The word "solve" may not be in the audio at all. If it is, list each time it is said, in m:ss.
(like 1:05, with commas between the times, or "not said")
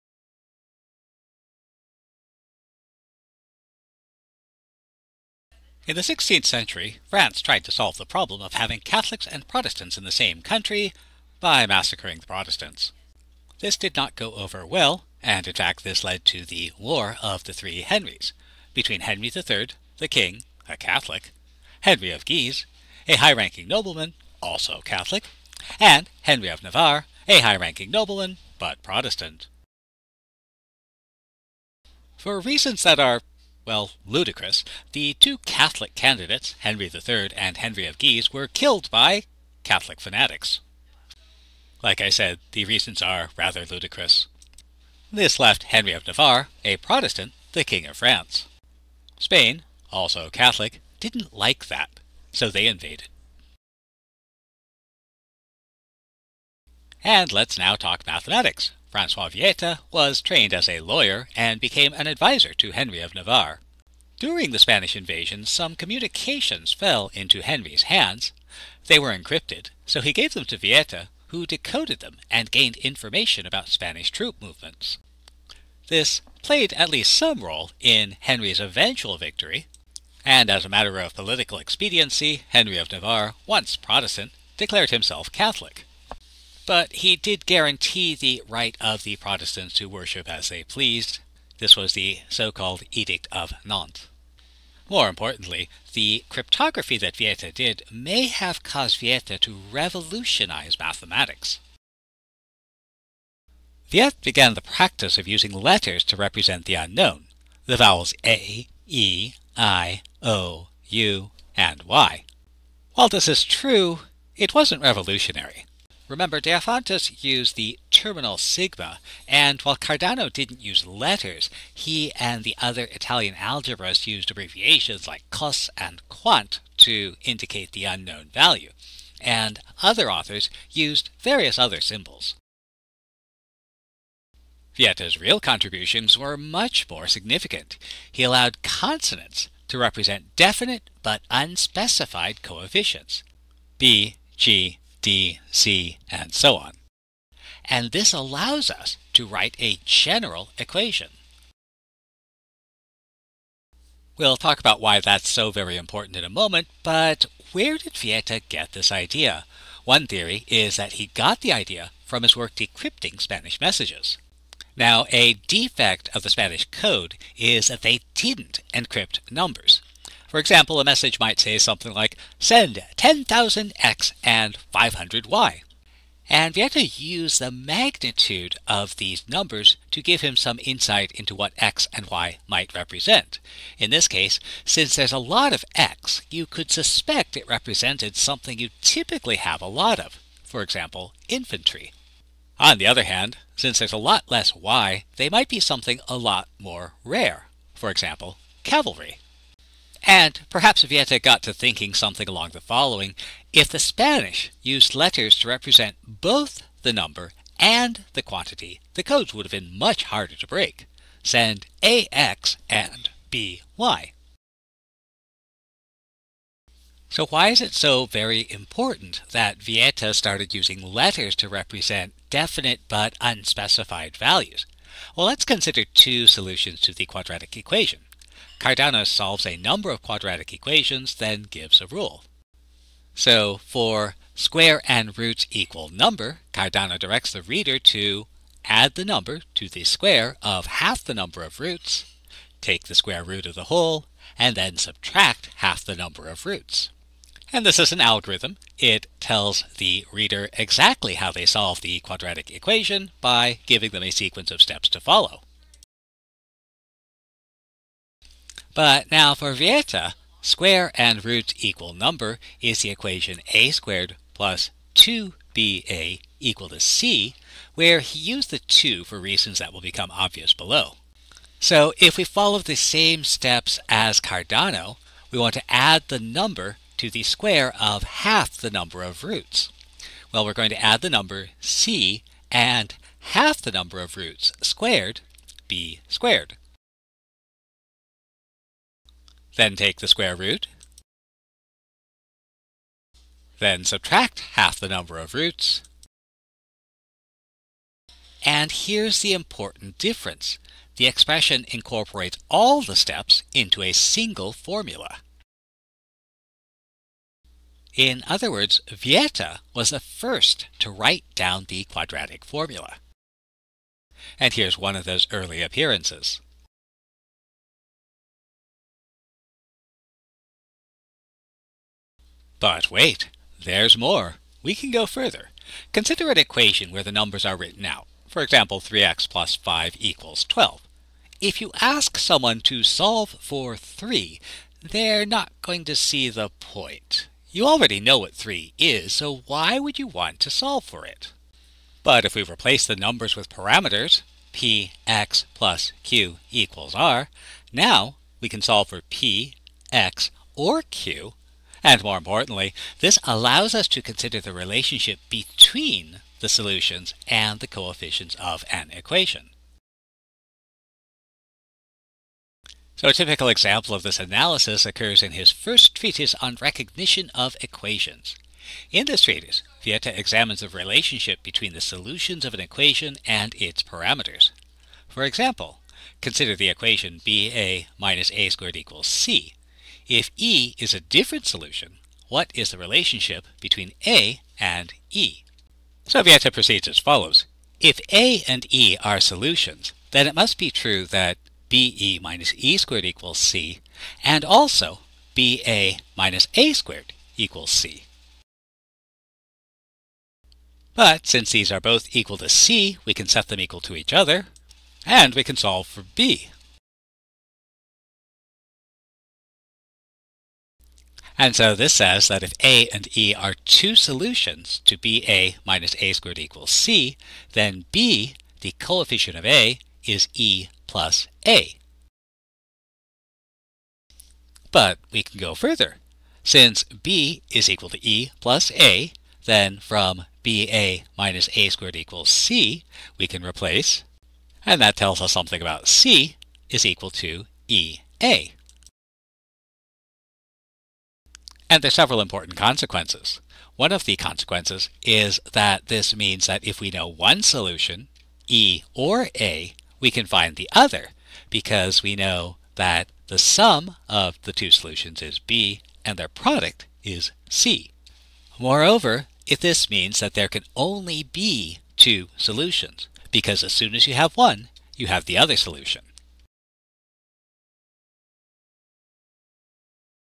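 0:07, 3:49, 4:11, 5:32, 5:40, 5:48, 6:45.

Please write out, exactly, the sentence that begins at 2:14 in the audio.
Vieta's real contributions were much more significant.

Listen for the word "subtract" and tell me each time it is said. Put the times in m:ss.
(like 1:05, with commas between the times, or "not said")
4:04, 4:53.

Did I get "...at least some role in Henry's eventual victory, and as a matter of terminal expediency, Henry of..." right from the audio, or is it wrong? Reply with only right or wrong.
wrong.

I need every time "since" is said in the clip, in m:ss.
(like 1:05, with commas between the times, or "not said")
3:04, 3:13, 6:41, 7:06.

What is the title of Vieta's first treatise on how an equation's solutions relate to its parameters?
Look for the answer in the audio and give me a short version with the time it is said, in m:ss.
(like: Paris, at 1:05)
recognition of equations, at 6:06.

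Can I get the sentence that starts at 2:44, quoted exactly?
Now, a defect of the Spanish code is that they didn't encrypt numbers.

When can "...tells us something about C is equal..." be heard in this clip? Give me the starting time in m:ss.
7:14.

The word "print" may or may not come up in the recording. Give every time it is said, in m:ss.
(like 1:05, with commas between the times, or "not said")
not said.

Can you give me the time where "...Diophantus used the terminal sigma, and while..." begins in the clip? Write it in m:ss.
1:56.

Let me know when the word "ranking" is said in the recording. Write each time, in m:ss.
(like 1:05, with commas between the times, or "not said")
0:23, 0:27.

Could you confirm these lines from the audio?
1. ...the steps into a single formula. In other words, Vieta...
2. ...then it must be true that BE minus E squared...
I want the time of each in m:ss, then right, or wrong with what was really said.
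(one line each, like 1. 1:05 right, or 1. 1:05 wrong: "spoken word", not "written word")
1. 5:02 right
2. 6:30 right.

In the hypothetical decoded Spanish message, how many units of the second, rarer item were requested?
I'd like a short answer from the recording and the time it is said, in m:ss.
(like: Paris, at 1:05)
500, at 2:54.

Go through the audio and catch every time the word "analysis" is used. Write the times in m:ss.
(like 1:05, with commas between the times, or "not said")
6:04.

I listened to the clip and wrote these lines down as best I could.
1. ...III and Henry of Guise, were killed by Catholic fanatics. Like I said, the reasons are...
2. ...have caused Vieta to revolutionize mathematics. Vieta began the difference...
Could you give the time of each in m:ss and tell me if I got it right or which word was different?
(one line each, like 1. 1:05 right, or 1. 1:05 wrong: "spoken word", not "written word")
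1. 0:36 right
2. 1:38 wrong: "practice", not "difference".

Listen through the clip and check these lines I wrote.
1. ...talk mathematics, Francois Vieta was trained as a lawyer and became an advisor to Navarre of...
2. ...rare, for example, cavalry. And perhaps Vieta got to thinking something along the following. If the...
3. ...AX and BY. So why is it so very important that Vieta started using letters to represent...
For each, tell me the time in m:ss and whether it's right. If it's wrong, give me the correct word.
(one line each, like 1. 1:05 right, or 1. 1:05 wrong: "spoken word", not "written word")
1. 0:57 wrong: "Henry", not "Navarre"
2. 3:17 right
3. 3:31 right.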